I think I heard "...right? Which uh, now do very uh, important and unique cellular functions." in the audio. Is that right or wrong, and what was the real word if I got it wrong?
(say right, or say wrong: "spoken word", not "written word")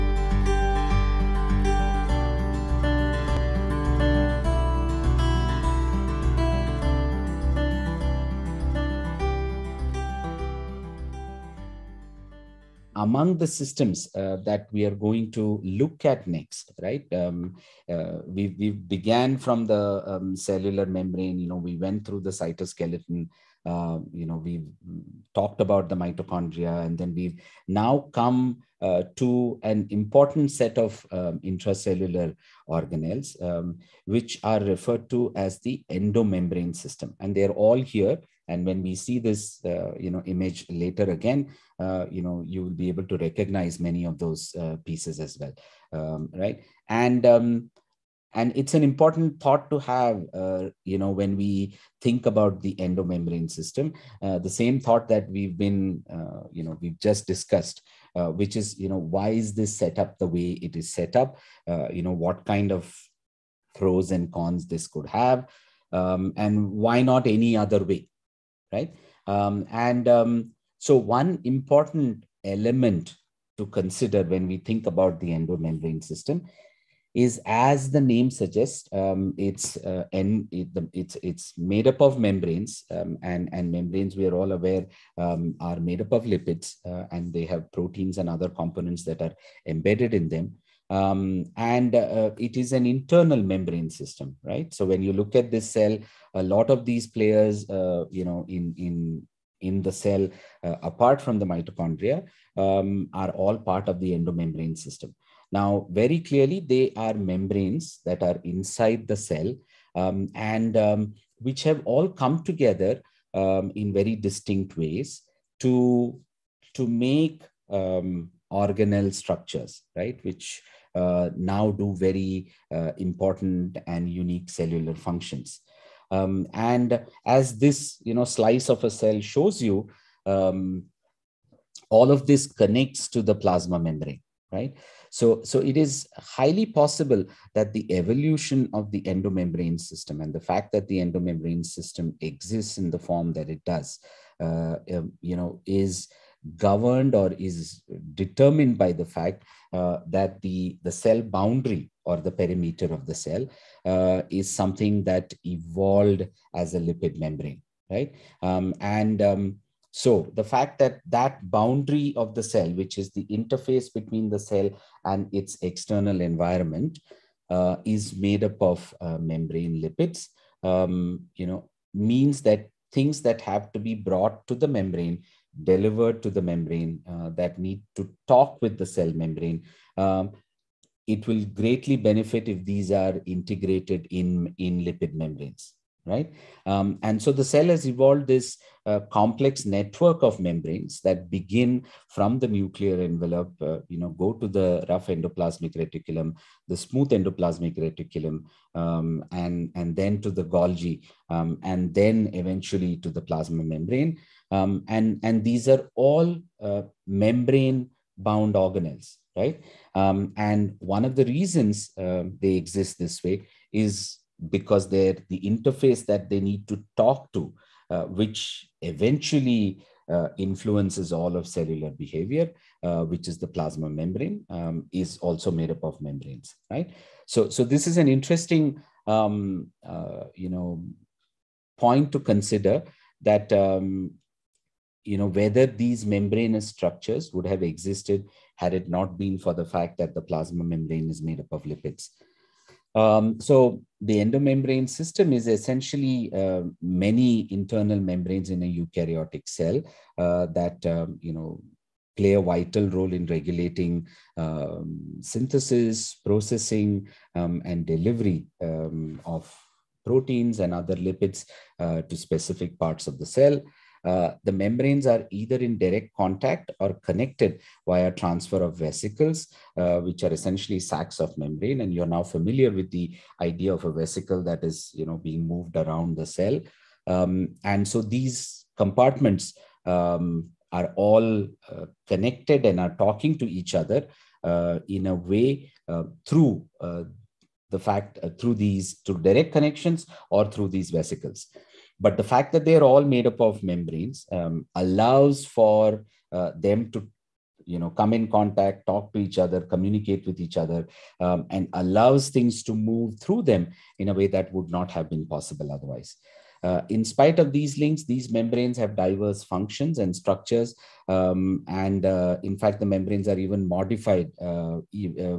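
right.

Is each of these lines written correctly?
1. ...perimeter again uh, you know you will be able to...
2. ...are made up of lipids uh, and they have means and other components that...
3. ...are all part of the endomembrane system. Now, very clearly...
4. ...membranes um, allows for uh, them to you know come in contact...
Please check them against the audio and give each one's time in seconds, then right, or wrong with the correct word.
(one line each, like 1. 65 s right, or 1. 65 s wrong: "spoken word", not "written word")
1. 40 s wrong: "later", not "perimeter"
2. 85 s wrong: "proteins", not "means"
3. 103 s right
4. 293 s right.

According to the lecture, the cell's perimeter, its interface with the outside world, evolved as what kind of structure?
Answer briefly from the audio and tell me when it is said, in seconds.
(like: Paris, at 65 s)
lipid membrane, at 156 s.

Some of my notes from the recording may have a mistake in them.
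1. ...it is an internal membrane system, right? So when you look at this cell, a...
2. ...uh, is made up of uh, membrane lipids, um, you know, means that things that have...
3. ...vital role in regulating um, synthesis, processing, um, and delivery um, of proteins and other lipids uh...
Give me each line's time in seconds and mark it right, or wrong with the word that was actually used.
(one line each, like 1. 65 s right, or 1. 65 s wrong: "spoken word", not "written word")
1. 92 s right
2. 167 s right
3. 252 s right.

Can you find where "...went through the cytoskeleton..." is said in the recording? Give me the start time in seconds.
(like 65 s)
21 s.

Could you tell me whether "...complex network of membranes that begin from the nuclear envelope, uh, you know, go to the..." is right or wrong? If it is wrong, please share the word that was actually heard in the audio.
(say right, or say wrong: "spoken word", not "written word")
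right.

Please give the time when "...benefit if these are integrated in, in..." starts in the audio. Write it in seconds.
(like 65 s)
181 s.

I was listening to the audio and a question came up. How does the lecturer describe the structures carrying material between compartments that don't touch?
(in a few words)
sacs of membrane.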